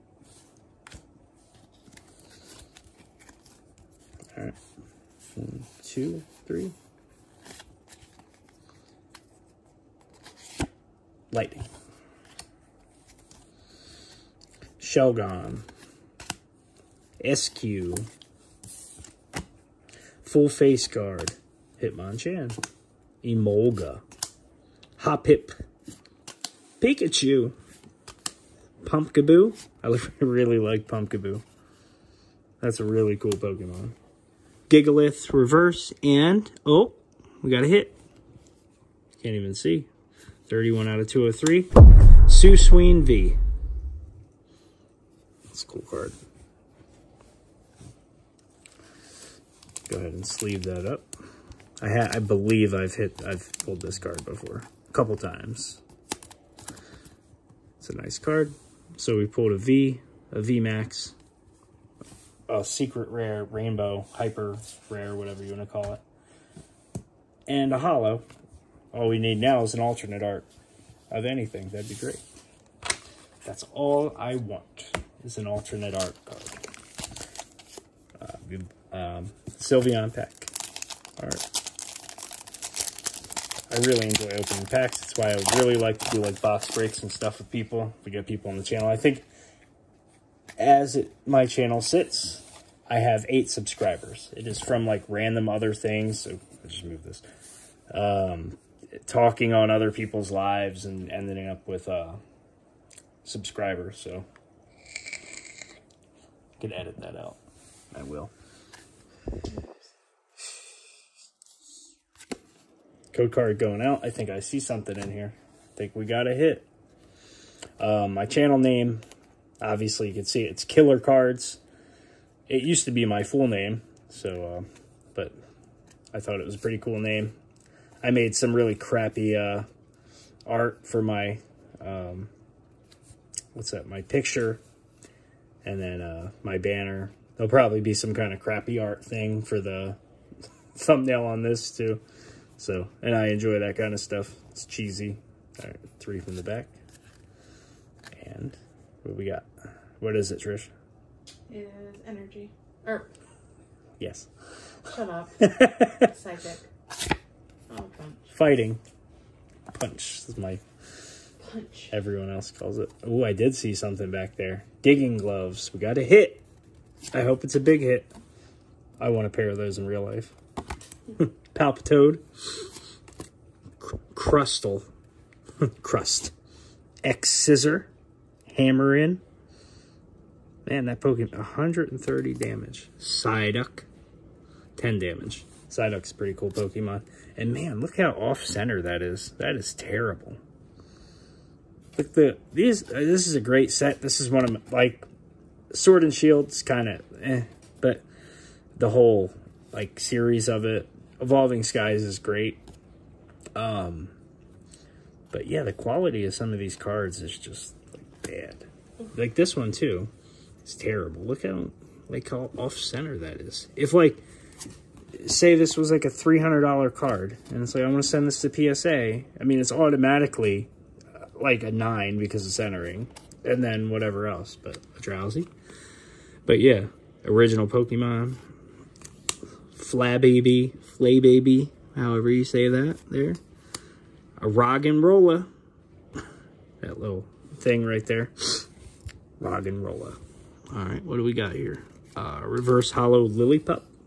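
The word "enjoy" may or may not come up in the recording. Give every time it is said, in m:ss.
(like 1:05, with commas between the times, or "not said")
1:24, 2:23.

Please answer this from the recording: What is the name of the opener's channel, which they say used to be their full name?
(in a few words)
Killerkards.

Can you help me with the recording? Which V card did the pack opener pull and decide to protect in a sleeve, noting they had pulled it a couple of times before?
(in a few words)
Suicune V.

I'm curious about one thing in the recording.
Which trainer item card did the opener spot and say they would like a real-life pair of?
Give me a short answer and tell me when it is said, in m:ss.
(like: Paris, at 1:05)
Digging gloves, at 2:44.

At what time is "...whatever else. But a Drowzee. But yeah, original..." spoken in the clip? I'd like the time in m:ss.
3:43.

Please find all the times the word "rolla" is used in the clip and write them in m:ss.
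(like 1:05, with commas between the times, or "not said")
3:55, 3:59.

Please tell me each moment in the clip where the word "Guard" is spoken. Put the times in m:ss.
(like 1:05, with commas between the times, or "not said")
0:20.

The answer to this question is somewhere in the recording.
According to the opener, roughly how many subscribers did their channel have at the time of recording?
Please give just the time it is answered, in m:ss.
1:33.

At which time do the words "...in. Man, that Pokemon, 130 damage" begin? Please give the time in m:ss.
2:58.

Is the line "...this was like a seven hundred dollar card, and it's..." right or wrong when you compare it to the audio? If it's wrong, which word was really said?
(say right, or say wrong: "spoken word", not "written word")
wrong: "three", not "seven".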